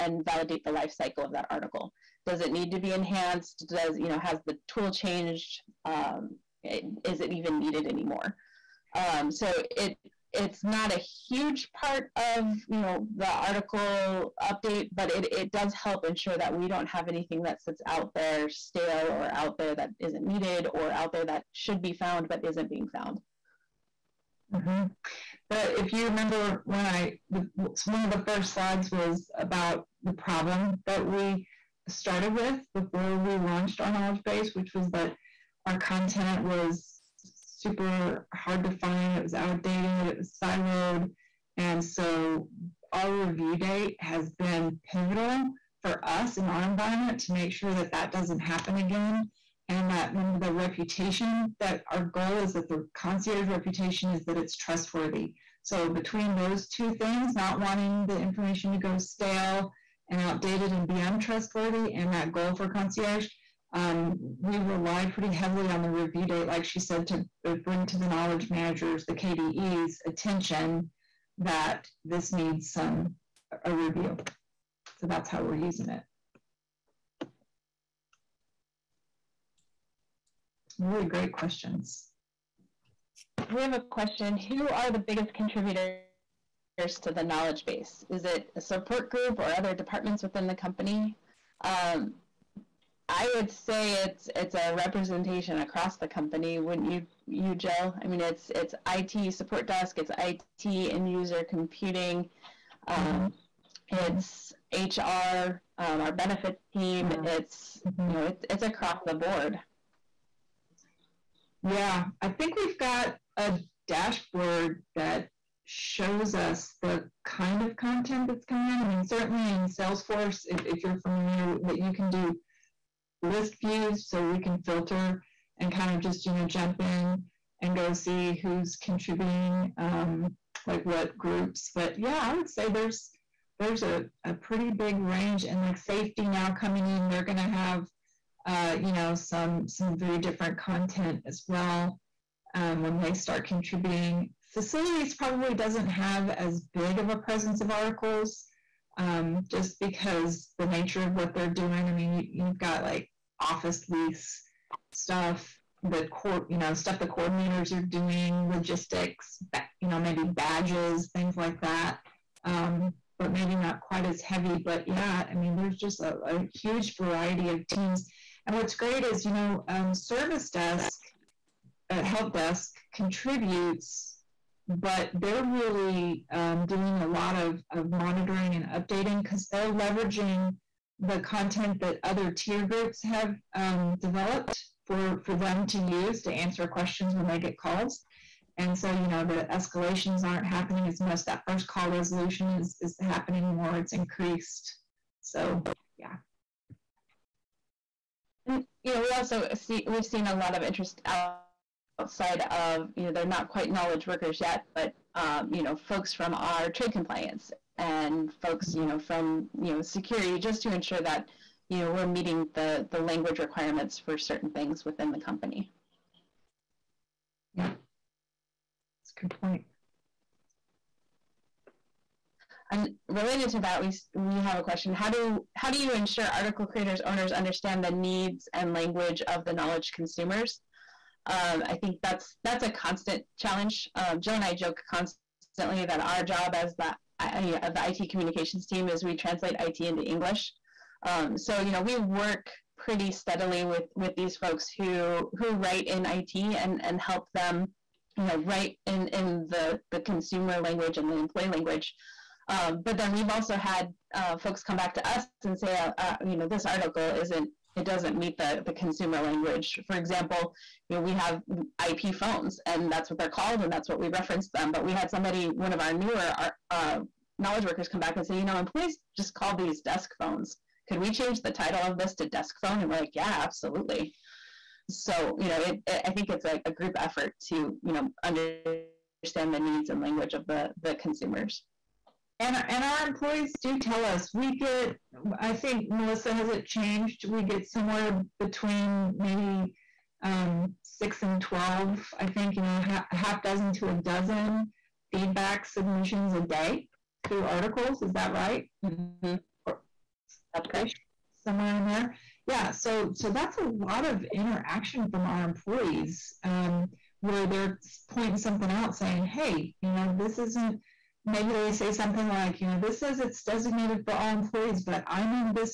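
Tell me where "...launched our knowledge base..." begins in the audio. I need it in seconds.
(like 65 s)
33 s.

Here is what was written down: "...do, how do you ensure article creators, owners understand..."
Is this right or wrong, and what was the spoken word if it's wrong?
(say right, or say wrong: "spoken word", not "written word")
right.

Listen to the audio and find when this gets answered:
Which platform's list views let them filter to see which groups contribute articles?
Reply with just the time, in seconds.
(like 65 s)
119 s.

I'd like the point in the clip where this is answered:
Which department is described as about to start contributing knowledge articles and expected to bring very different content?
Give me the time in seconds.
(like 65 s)
135 s.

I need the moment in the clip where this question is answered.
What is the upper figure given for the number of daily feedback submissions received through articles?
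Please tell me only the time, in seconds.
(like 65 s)
291 s.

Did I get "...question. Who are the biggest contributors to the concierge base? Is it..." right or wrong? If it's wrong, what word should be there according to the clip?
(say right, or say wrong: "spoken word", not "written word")
wrong: "knowledge", not "concierge".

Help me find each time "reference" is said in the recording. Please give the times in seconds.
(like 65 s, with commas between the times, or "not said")
264 s.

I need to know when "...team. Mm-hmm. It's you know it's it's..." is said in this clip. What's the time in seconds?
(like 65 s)
106 s.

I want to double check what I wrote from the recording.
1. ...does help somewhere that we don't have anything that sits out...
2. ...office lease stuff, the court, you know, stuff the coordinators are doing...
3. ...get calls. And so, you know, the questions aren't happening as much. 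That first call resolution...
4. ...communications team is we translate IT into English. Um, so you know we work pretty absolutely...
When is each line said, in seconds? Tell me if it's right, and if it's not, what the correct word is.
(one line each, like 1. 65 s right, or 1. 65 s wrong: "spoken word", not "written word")
1. 15 s wrong: "ensure", not "somewhere"
2. 153 s right
3. 187 s wrong: "escalations", not "questions"
4. 238 s wrong: "steadily", not "absolutely".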